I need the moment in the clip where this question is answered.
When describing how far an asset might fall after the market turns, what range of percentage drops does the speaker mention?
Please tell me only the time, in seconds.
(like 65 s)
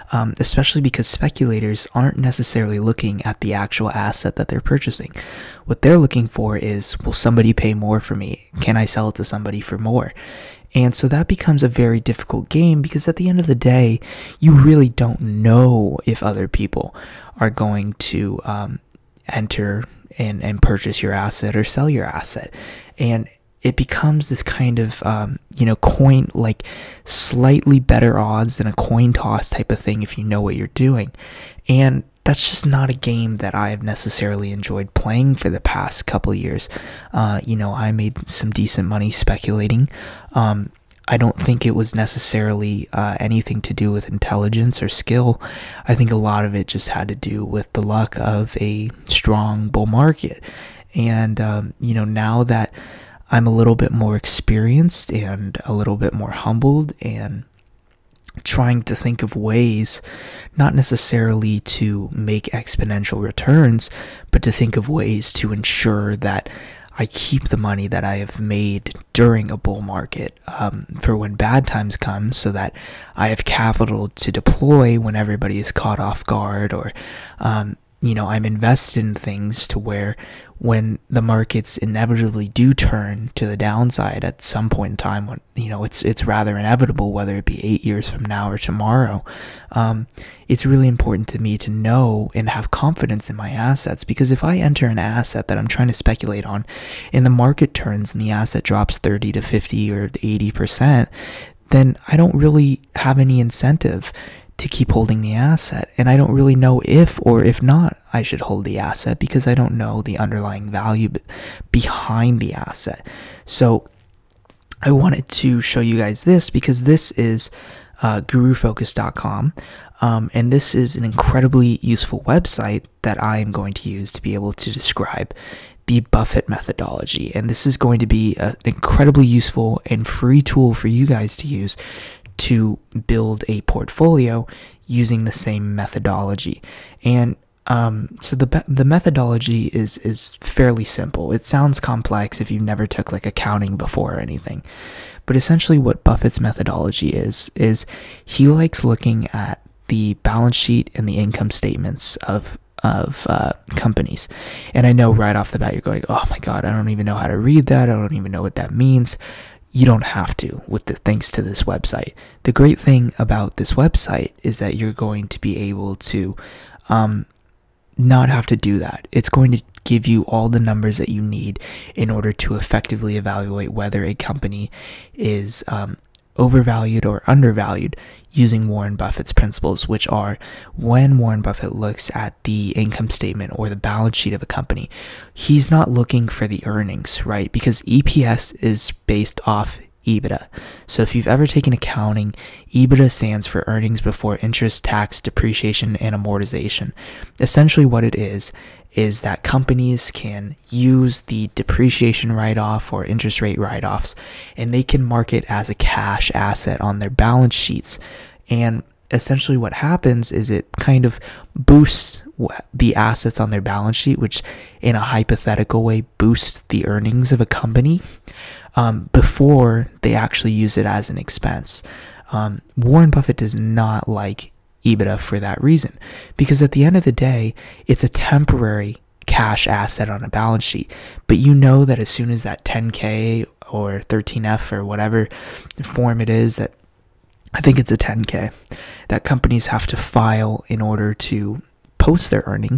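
98 s.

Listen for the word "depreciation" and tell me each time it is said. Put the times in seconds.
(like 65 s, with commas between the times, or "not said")
195 s, 201 s.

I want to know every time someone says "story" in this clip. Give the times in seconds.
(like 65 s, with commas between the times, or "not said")
not said.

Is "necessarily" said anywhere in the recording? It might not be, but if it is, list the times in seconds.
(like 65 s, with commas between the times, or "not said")
2 s, 33 s, 41 s, 60 s.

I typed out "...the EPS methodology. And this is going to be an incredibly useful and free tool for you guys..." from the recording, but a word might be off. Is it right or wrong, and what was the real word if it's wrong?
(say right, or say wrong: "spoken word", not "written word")
wrong: "Buffett", not "EPS".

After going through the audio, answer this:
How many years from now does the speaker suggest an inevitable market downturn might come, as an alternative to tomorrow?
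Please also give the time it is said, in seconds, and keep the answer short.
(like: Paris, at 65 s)
8, at 87 s.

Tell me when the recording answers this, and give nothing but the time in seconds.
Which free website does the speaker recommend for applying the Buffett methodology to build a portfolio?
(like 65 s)
118 s.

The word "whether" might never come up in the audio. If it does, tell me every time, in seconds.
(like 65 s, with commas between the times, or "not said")
87 s, 173 s.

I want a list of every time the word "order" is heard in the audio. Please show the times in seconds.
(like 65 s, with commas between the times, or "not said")
172 s, 240 s.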